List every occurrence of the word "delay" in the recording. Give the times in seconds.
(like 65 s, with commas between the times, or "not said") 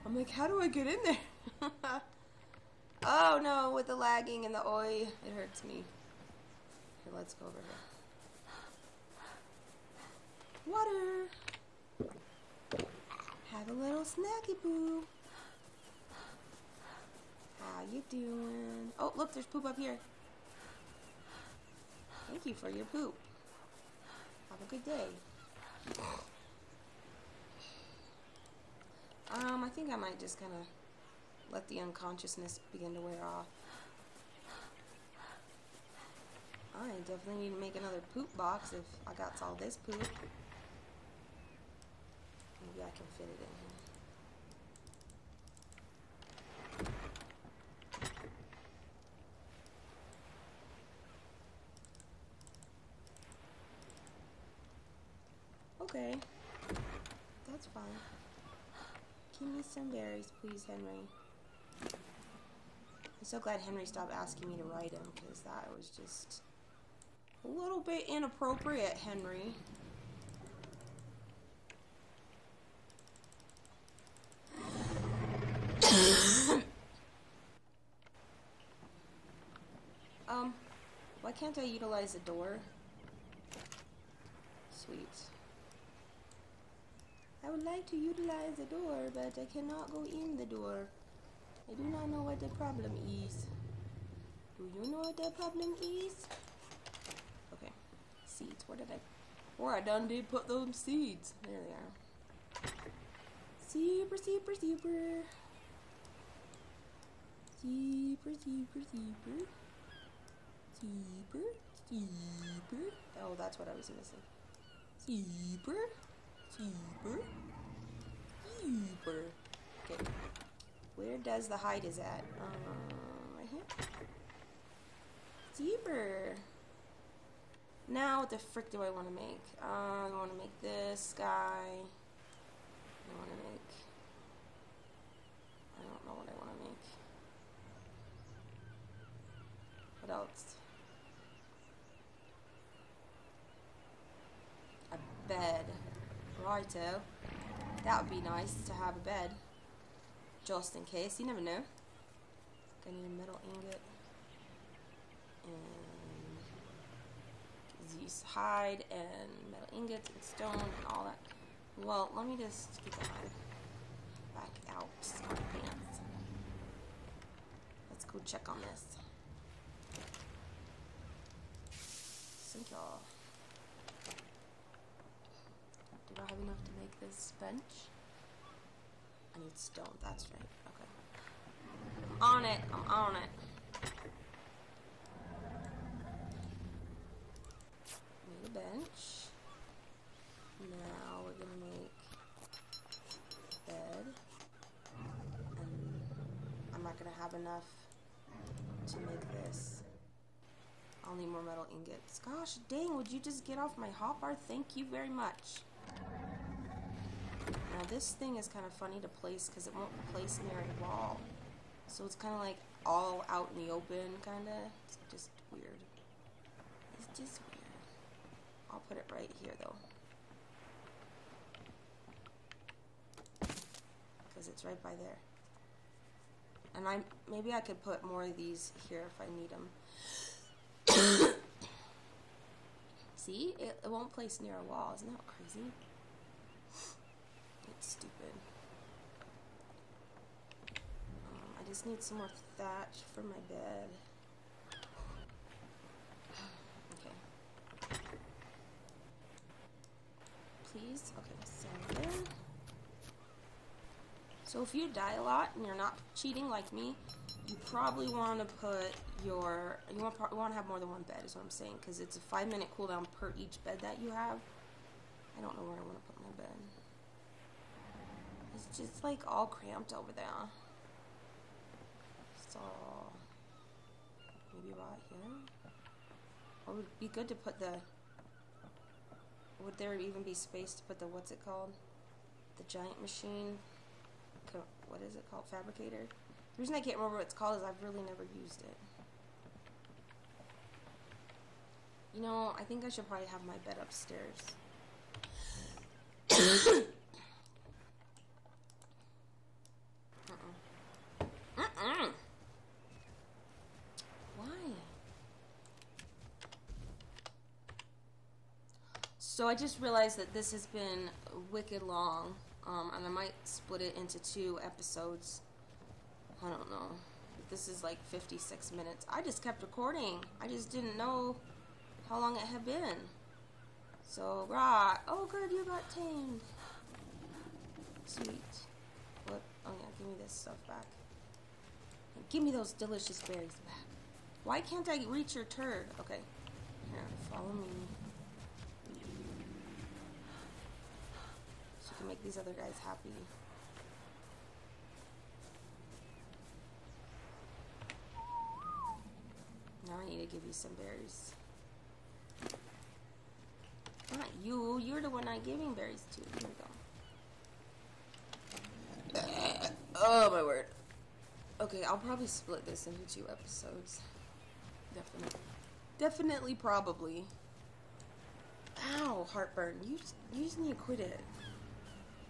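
not said.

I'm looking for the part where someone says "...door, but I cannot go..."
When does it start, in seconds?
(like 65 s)
88 s.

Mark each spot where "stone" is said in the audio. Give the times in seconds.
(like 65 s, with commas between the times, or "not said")
160 s, 179 s.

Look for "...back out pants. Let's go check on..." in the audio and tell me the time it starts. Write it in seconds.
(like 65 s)
164 s.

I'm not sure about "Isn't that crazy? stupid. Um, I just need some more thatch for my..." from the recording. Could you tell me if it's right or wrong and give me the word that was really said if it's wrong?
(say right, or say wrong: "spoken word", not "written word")
right.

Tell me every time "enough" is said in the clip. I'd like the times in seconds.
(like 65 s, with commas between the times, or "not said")
176 s, 197 s.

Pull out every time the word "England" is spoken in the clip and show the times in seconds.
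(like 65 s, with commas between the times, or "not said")
not said.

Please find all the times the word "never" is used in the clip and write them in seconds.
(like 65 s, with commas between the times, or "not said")
151 s, 288 s.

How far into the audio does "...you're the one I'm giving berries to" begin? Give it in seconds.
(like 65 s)
354 s.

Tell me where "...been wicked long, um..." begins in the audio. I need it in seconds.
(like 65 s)
310 s.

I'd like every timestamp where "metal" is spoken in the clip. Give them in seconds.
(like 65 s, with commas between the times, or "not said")
153 s, 159 s, 201 s.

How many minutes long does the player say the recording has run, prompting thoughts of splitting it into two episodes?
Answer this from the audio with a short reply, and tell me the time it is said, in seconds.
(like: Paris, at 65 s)
56, at 317 s.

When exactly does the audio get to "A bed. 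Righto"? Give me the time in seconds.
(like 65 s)
144 s.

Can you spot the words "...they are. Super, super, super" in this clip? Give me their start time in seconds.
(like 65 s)
101 s.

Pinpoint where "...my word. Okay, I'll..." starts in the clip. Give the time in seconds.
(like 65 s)
360 s.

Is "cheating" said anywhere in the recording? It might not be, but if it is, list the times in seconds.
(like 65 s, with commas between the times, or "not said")
256 s.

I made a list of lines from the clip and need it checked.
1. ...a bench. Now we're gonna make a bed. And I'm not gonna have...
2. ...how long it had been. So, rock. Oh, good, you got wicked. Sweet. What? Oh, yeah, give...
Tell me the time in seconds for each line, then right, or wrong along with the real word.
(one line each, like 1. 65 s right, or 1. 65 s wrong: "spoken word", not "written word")
1. 188 s right
2. 322 s wrong: "tamed", not "wicked".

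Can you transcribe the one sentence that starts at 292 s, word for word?
You know, I think I should probably have my bed upstairs.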